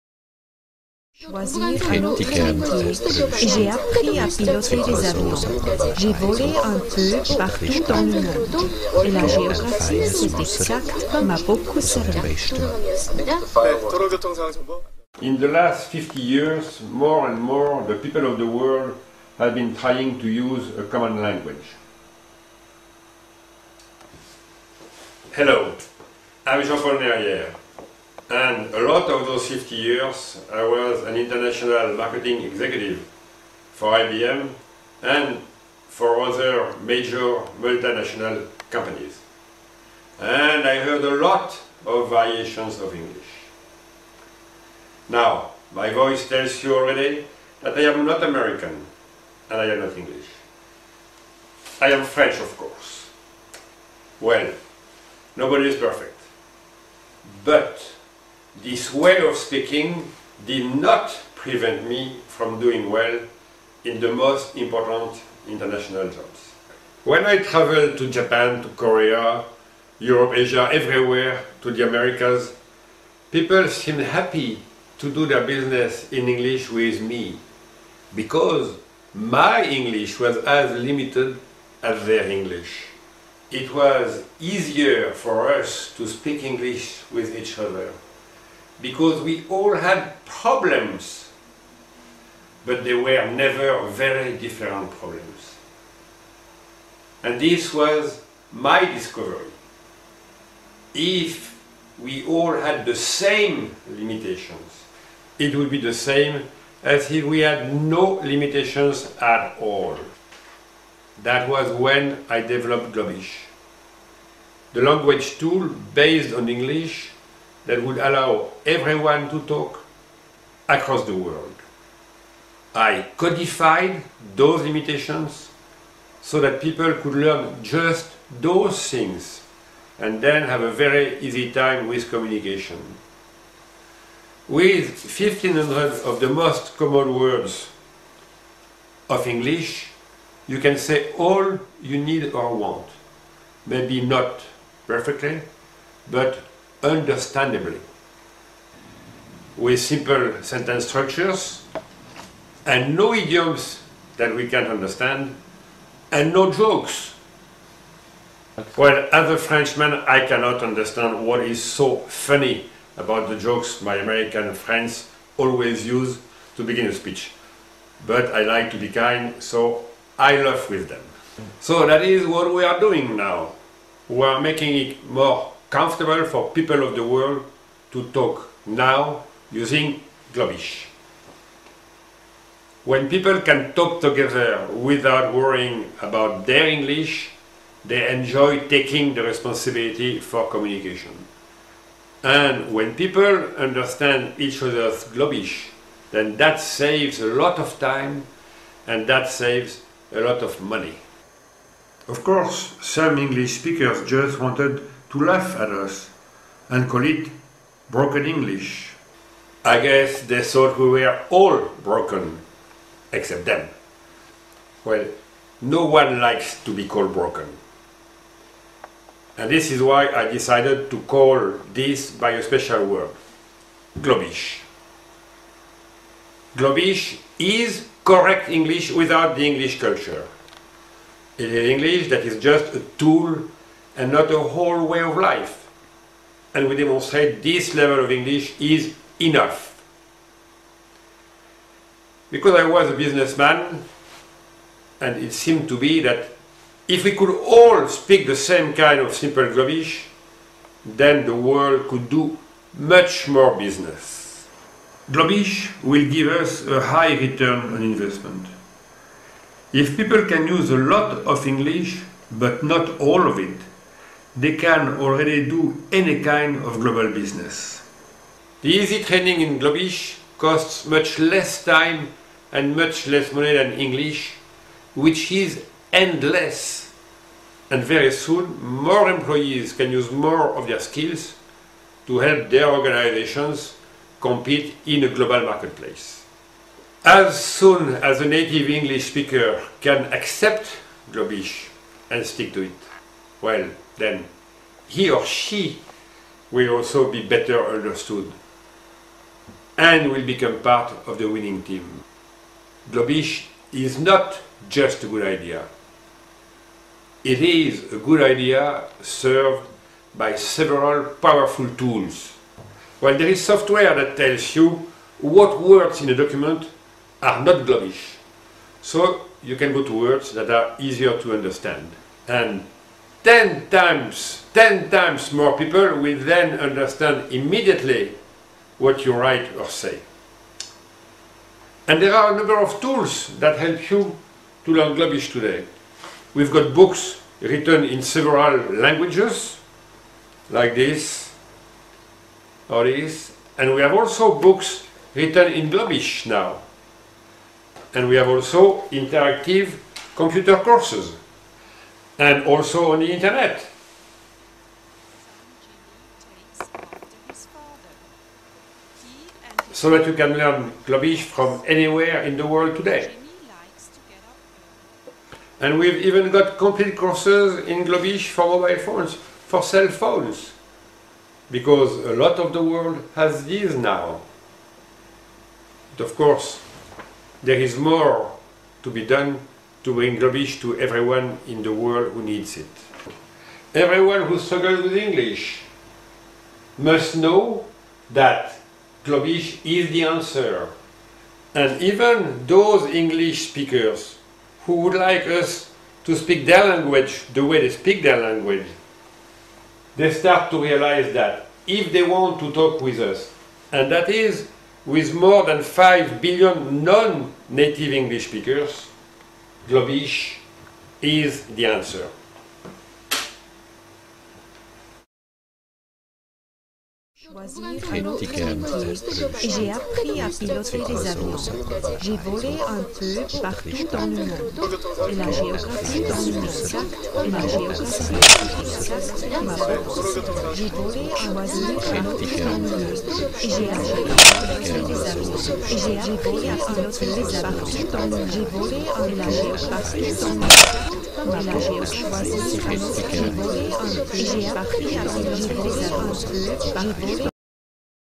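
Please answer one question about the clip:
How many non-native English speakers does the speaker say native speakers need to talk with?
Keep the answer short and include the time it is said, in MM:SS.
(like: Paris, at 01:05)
more than 5 billion, at 06:45.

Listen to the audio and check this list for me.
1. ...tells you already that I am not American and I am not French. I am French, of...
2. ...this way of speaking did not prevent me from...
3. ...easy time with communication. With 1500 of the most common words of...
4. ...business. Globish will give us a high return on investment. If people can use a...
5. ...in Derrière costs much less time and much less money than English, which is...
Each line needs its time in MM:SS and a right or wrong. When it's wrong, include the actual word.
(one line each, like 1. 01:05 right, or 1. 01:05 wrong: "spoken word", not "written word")
1. 00:46 wrong: "English", not "French"
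2. 00:58 right
3. 02:11 right
4. 04:13 right
5. 04:29 wrong: "Globish", not "Derrière".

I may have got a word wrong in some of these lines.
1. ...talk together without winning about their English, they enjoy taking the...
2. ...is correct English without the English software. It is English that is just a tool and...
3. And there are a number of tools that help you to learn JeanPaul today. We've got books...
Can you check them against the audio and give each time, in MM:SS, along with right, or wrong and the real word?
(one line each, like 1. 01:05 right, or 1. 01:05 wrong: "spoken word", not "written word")
1. 03:03 wrong: "worrying", not "winning"
2. 03:47 wrong: "culture", not "software"
3. 05:31 wrong: "Globish", not "JeanPaul".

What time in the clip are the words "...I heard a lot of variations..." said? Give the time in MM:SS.
00:40.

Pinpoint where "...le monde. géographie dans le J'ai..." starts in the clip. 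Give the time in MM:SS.
07:06.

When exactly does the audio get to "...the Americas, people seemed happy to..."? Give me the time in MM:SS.
01:11.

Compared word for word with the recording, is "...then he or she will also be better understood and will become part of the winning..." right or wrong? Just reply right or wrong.
right.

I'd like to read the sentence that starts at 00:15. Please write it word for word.
In the last 50 years, more and more the people of the world have been trying to use a common language.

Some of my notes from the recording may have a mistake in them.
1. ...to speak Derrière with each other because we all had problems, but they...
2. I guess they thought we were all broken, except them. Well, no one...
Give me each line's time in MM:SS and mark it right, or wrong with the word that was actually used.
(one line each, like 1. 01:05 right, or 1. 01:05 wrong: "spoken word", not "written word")
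1. 01:25 wrong: "English", not "Derrière"
2. 03:29 right.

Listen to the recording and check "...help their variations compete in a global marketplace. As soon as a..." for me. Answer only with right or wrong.
wrong.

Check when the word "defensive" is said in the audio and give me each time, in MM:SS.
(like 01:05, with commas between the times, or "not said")
not said.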